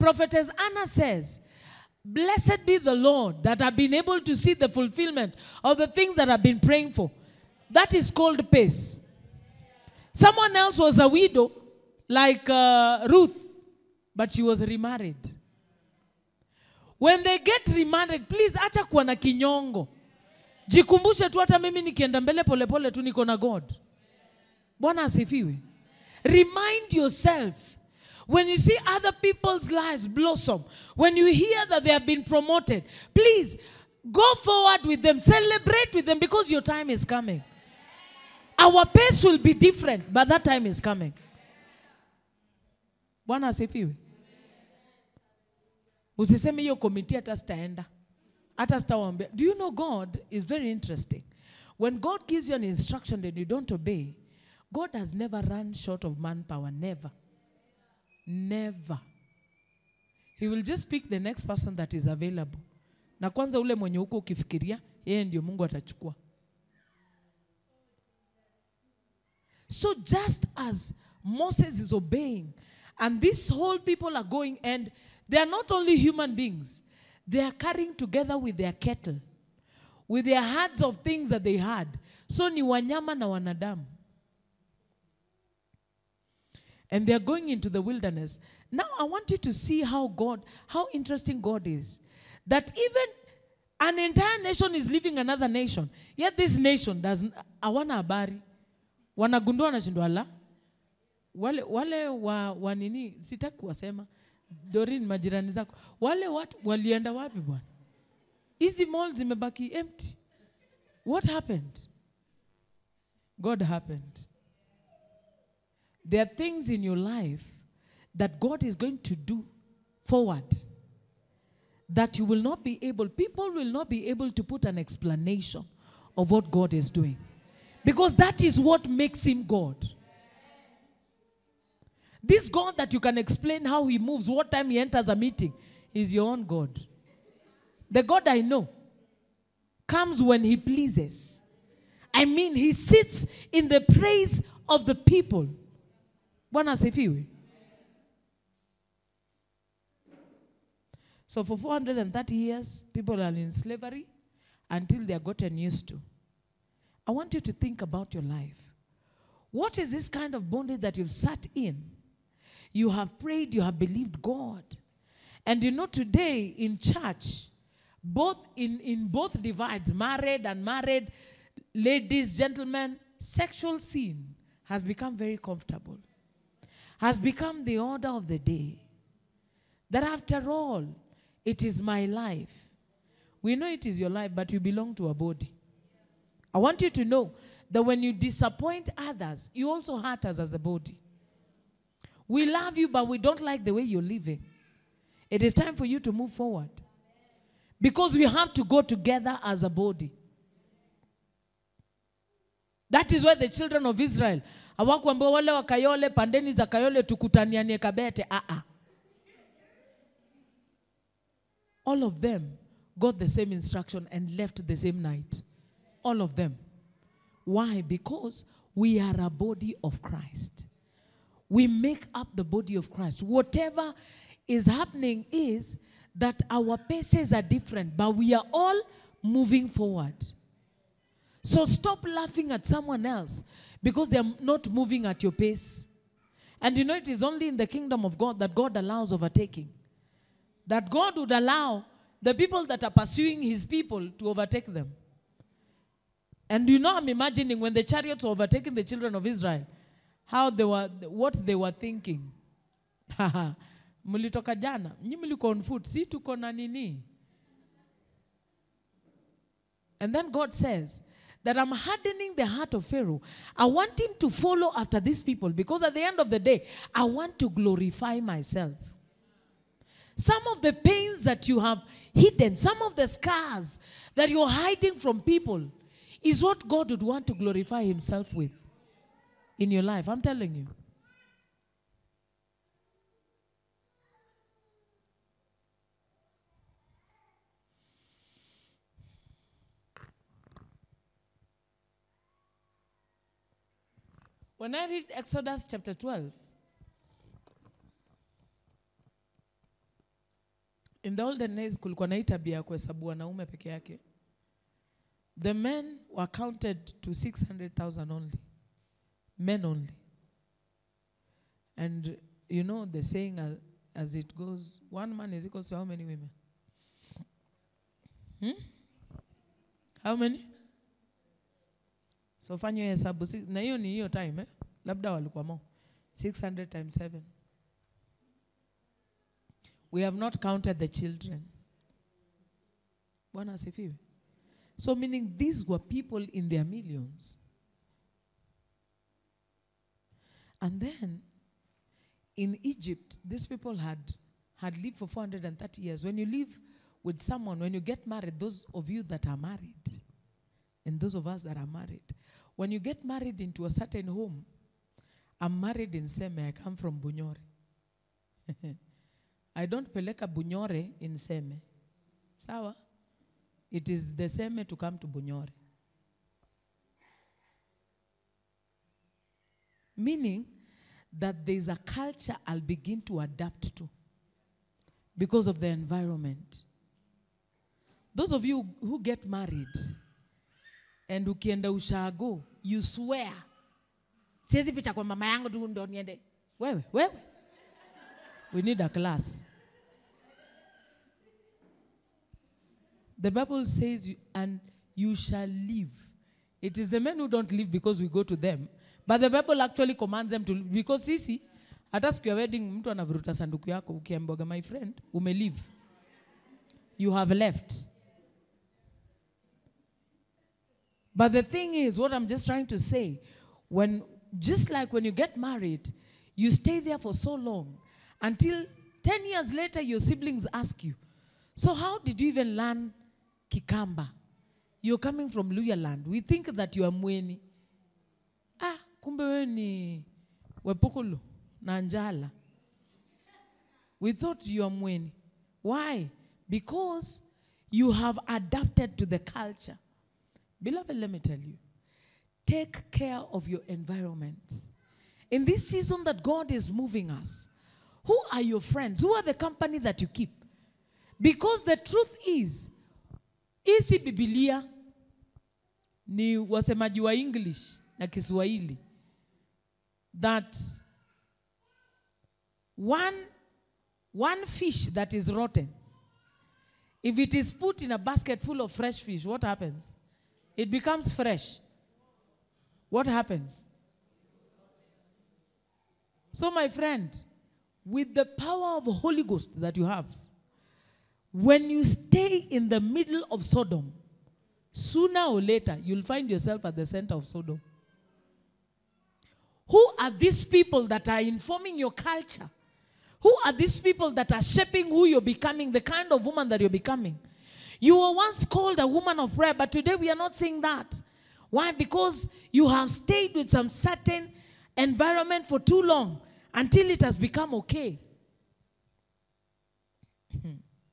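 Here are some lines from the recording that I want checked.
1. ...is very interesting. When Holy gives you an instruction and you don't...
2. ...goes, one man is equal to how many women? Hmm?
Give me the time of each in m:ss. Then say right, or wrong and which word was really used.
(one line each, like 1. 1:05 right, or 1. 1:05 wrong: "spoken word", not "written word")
1. 0:50 wrong: "God", not "Holy"
2. 5:14 right.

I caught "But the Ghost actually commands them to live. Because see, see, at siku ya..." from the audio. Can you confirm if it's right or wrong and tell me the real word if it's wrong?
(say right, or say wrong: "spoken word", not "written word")
wrong: "Bible", not "Ghost".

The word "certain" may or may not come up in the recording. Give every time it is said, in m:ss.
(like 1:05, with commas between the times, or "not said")
5:53, 8:23.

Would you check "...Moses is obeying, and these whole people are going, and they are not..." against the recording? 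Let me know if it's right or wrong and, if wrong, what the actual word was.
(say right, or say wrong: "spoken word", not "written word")
right.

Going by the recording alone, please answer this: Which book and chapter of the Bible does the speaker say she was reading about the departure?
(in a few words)
Exodus chapter 12.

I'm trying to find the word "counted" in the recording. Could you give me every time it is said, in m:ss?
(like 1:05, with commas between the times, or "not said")
5:06, 5:30.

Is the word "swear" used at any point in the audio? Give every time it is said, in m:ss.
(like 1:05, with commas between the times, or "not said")
6:22.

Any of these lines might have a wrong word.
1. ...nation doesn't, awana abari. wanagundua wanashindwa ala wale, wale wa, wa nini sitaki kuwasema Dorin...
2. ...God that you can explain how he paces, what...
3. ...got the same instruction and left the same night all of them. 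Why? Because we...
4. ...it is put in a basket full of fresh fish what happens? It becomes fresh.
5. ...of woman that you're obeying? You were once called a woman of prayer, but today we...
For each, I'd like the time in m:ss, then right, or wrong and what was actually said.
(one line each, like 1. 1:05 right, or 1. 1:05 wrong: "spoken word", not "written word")
1. 1:36 right
2. 2:12 wrong: "moves", not "paces"
3. 3:32 right
4. 7:47 right
5. 8:16 wrong: "becoming", not "obeying".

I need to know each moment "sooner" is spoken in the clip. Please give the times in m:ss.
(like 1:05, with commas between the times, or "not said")
8:04.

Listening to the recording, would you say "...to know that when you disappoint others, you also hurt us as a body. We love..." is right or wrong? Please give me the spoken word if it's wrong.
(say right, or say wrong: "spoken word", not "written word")
right.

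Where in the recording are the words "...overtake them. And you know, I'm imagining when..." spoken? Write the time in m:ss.
4:04.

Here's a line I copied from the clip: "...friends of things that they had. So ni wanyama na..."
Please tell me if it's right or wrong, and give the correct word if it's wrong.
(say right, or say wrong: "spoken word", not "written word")
wrong: "herds", not "friends".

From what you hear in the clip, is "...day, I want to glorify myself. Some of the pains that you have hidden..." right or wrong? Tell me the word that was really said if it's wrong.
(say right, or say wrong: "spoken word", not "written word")
right.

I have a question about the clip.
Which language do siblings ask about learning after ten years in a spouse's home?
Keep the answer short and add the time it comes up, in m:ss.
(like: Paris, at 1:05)
Kikamba, at 7:03.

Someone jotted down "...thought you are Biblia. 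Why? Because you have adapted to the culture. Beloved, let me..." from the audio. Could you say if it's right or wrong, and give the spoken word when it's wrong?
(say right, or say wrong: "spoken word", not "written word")
wrong: "Mweni", not "Biblia".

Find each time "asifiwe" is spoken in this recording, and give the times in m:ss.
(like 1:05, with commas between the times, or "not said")
0:25, 0:43, 2:26.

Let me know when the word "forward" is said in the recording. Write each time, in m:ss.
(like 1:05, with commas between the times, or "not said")
0:34, 2:00, 3:16, 3:49.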